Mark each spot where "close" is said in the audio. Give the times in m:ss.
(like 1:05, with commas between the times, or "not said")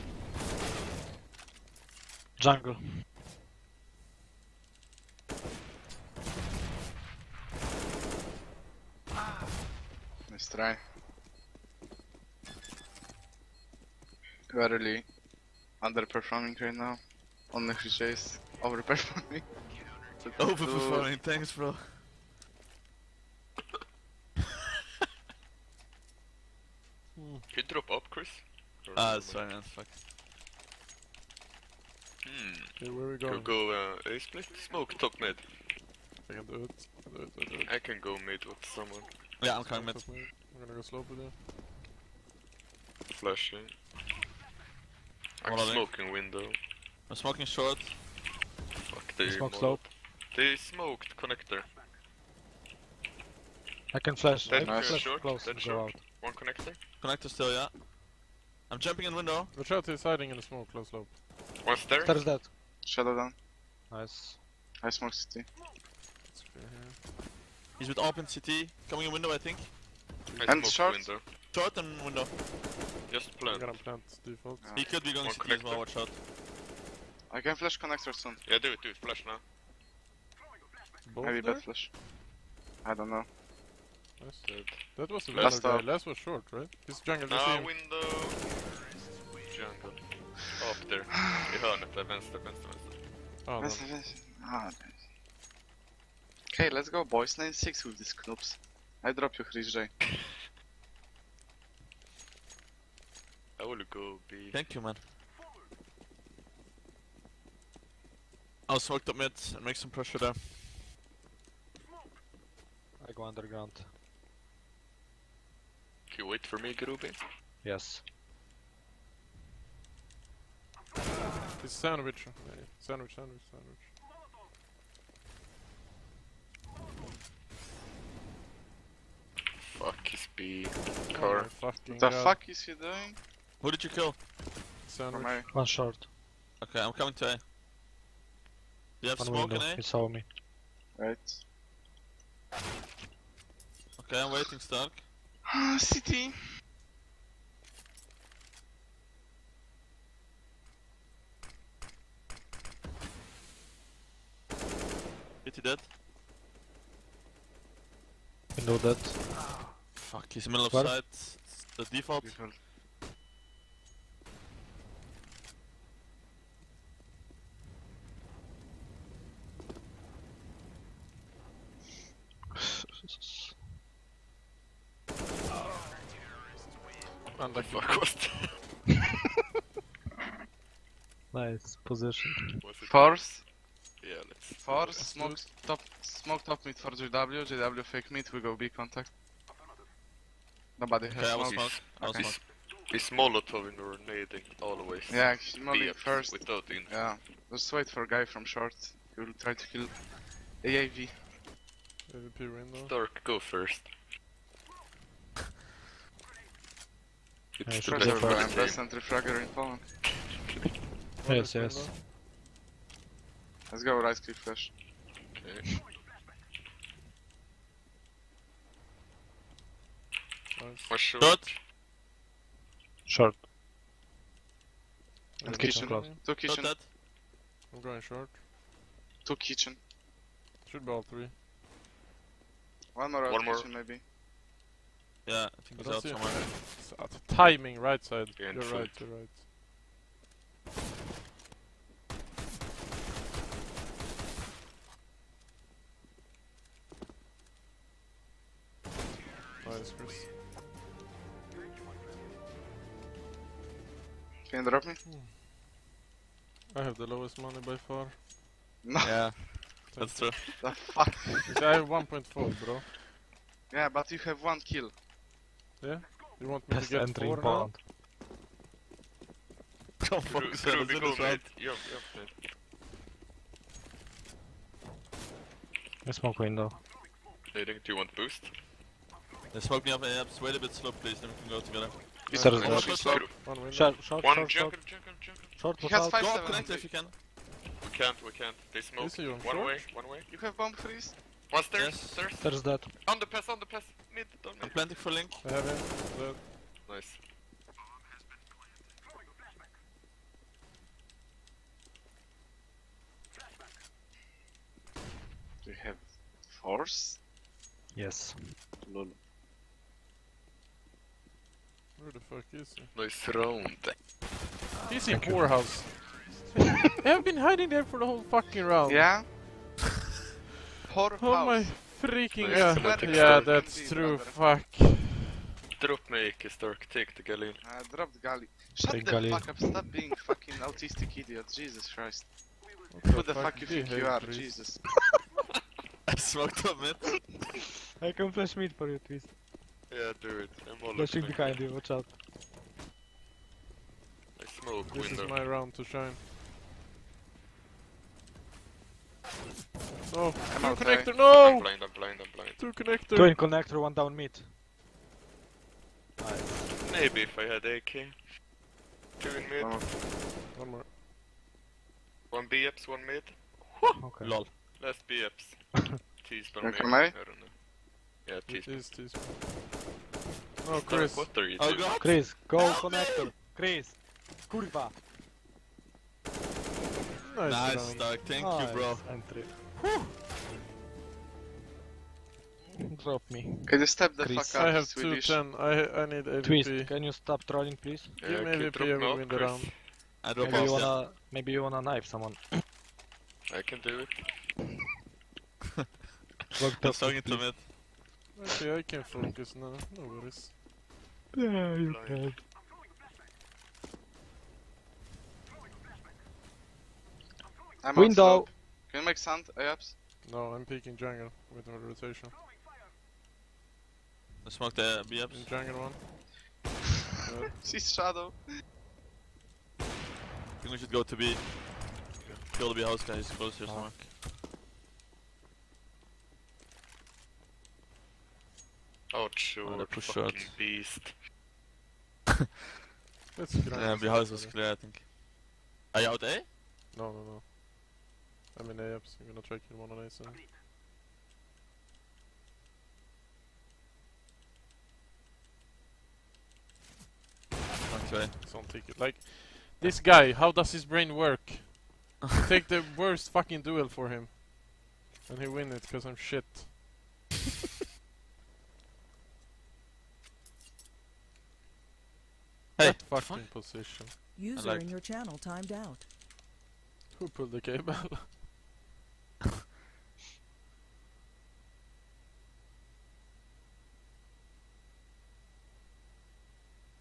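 0:55, 1:00, 7:03.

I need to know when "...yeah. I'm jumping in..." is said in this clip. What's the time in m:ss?
0:57.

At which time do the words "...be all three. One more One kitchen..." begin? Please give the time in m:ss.
3:50.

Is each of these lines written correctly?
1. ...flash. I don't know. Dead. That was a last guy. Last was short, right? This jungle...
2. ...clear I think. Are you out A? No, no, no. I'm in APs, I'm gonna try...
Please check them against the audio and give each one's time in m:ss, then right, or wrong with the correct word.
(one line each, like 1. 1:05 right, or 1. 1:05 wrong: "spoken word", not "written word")
1. 1:21 right
2. 7:14 right.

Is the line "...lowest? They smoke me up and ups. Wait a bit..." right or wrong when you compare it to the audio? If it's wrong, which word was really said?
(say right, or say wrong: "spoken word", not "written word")
wrong: "boost", not "lowest".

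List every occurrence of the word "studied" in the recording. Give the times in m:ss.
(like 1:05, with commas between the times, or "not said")
not said.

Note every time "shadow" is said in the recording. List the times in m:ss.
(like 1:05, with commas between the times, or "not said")
1:02, 6:57.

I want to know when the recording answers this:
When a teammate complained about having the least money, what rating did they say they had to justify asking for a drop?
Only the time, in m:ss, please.
4:21.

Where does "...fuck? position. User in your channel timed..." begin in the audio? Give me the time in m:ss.
7:43.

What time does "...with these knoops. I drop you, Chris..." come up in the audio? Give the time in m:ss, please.
1:37.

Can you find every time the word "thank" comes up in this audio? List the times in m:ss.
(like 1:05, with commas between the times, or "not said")
0:21, 1:44, 6:18.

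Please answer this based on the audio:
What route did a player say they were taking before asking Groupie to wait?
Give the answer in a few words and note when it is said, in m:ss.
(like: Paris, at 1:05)
underground, at 1:53.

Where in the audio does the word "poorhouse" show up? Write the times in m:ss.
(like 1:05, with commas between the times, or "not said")
5:15, 5:20.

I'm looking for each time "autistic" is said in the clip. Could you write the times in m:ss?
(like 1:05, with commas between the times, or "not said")
5:30.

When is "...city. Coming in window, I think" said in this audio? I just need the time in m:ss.
1:08.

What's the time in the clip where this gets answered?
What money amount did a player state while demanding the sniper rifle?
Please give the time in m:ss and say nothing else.
6:25.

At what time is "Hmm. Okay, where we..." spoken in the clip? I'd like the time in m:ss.
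0:32.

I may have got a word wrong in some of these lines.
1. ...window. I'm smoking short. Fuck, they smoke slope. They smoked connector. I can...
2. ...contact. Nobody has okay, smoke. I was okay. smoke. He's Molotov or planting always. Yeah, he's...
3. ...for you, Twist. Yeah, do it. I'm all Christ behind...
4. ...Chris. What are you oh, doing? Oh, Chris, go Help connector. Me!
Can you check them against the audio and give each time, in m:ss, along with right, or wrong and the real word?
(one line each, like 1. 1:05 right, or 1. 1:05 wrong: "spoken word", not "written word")
1. 0:46 right
2. 3:08 wrong: "grenading", not "planting"
3. 5:38 wrong: "Flashing", not "Christ"
4. 6:10 right.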